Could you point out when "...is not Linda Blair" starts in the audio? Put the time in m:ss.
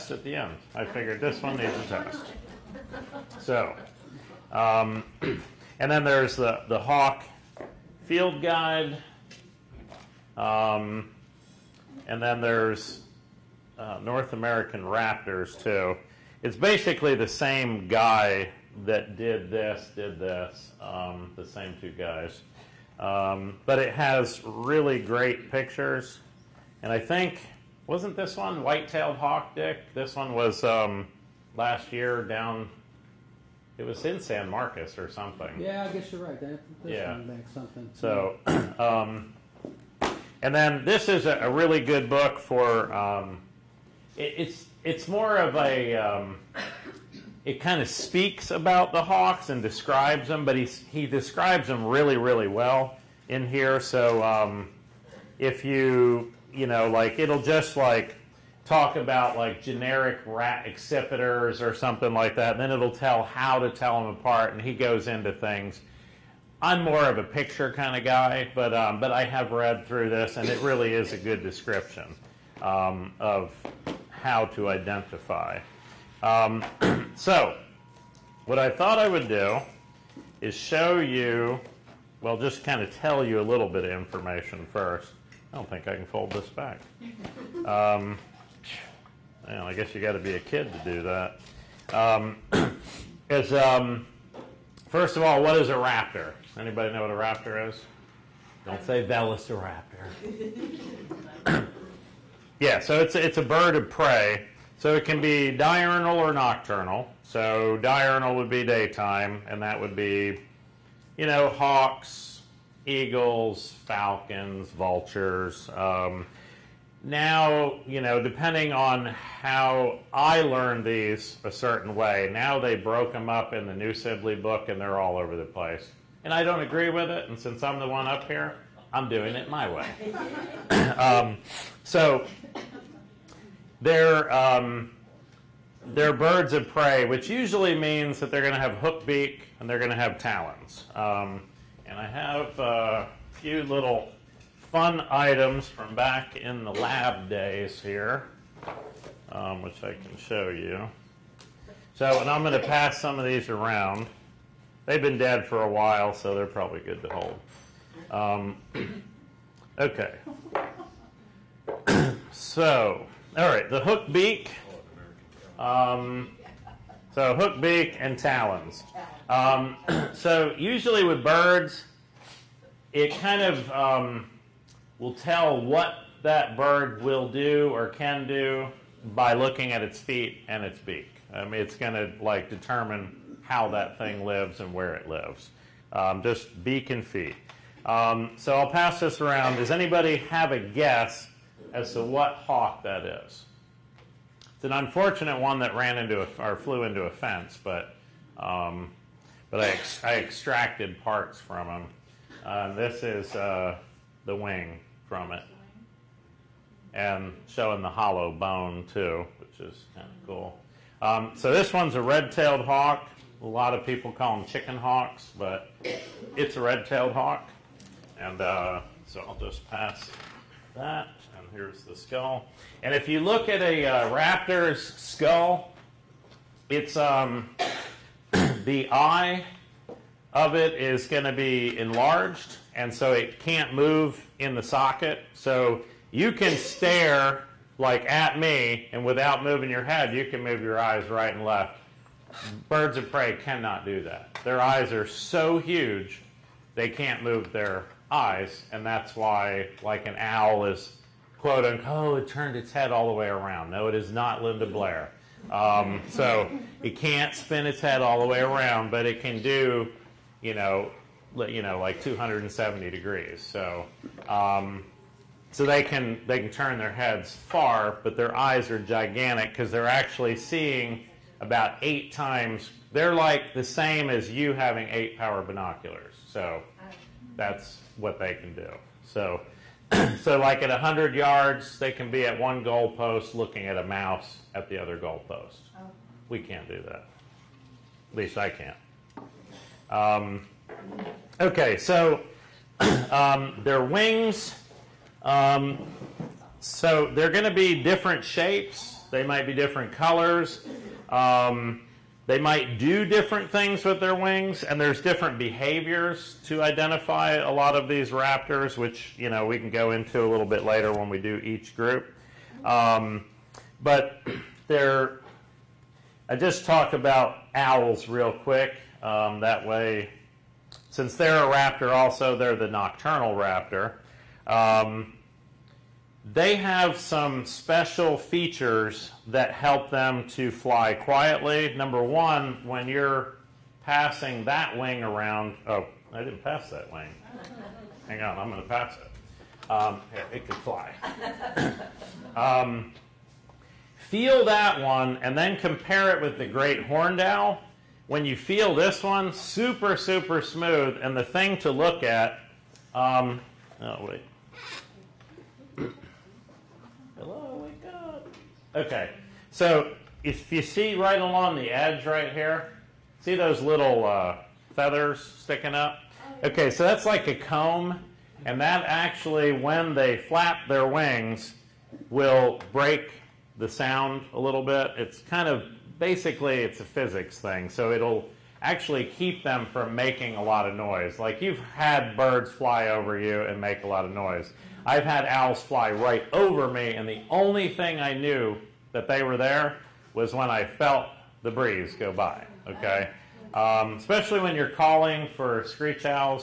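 4:13.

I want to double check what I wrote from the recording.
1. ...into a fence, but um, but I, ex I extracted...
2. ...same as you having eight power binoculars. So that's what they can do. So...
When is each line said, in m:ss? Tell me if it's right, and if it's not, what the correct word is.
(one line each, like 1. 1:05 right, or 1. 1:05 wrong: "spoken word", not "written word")
1. 3:16 right
2. 4:33 right.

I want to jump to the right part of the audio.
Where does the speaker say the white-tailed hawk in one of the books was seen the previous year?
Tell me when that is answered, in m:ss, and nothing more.
0:34.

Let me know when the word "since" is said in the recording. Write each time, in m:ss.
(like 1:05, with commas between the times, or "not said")
2:07, 5:20.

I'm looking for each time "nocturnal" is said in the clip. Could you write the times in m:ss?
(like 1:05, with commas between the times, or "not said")
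1:46, 5:22.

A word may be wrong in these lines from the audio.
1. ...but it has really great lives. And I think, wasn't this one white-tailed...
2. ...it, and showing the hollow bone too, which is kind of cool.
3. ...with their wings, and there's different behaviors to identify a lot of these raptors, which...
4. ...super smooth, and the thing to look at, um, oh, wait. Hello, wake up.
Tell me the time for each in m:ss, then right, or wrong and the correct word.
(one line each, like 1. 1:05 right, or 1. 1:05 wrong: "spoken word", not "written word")
1. 0:23 wrong: "pictures", not "lives"
2. 3:25 right
3. 5:03 right
4. 5:49 right.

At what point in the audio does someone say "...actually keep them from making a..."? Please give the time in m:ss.
6:18.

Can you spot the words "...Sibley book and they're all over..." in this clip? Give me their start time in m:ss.
2:03.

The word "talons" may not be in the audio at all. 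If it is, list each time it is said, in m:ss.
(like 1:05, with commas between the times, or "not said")
2:20, 2:48.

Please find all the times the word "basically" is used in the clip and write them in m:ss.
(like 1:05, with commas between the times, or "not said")
0:16, 6:15.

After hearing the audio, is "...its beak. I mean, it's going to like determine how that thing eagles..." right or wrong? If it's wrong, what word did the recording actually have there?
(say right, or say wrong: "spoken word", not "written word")
wrong: "lives", not "eagles".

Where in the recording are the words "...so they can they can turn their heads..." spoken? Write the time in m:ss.
4:25.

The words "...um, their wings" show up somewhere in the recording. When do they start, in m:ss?
4:53.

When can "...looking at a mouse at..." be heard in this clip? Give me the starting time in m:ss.
4:43.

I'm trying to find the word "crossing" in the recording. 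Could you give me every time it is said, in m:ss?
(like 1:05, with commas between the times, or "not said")
not said.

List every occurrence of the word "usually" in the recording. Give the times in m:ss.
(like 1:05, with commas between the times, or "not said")
2:17, 2:50.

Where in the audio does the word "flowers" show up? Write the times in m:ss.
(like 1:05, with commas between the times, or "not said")
not said.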